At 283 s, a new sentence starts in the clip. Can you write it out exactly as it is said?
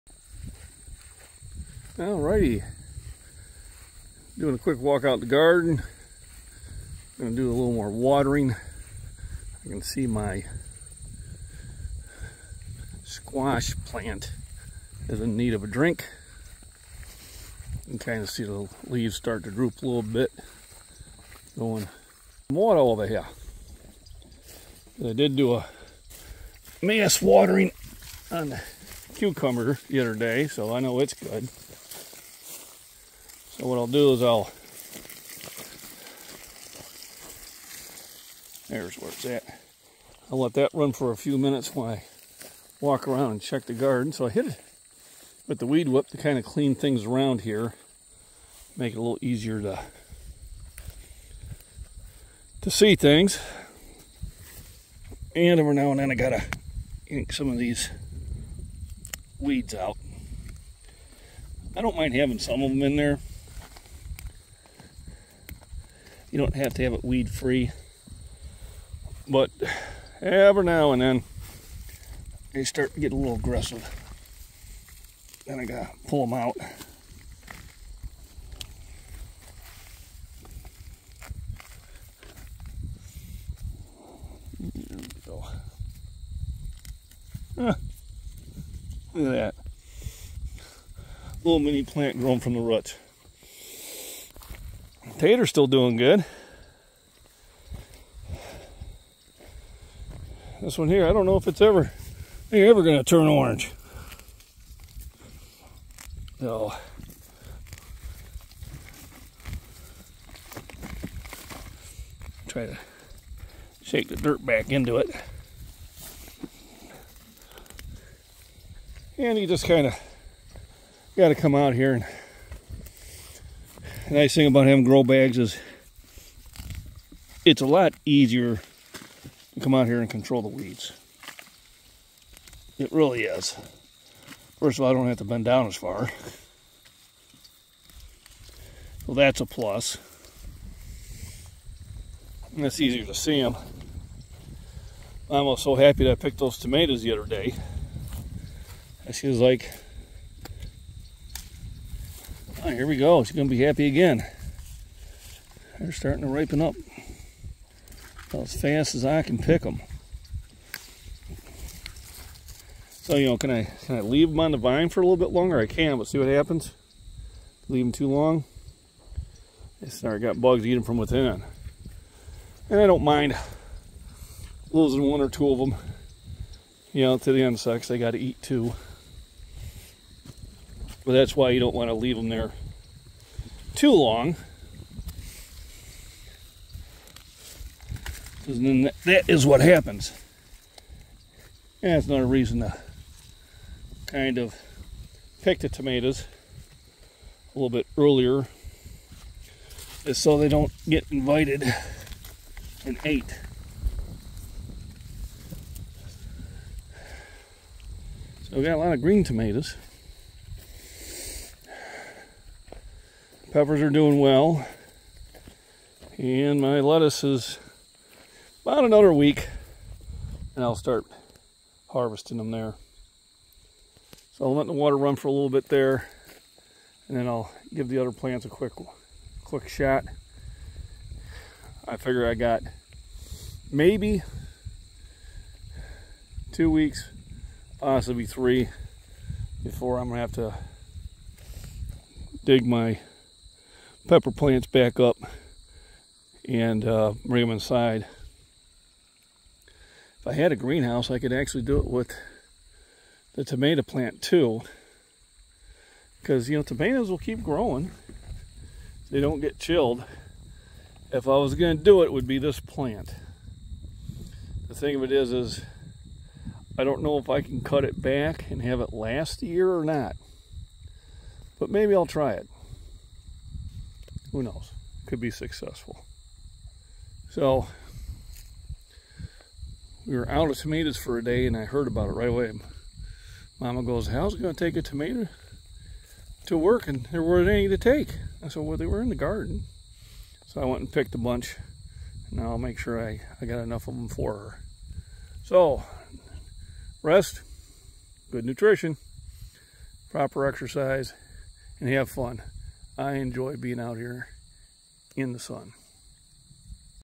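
Mama goes, how's it gonna take a tomato to work?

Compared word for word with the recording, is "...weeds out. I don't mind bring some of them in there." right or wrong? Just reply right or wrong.
wrong.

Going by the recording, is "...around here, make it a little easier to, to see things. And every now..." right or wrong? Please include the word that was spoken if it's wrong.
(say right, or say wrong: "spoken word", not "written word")
right.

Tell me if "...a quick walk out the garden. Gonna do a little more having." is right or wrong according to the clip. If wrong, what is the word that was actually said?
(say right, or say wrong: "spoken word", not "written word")
wrong: "watering", not "having".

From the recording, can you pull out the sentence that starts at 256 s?
Because, you know, tomatoes will keep growing.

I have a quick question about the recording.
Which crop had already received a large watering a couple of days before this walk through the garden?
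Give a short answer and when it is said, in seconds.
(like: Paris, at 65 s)
Cucumber, at 29 s.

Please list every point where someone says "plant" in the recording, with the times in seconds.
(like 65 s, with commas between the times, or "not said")
13 s, 91 s, 228 s, 244 s, 253 s, 262 s.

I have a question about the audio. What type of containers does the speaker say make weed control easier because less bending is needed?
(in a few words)
Grow bags.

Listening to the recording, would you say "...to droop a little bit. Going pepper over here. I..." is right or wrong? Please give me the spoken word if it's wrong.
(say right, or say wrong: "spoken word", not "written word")
wrong: "water", not "pepper".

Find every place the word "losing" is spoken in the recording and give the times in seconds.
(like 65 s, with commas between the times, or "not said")
174 s.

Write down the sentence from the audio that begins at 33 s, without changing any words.
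So what I'll do is I'll, there's where it's at.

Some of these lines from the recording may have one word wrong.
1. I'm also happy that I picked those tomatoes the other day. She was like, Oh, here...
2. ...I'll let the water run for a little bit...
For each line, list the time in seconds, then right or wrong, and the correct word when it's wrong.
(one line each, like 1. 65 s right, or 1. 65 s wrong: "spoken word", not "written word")
1. 145 s right
2. 224 s right.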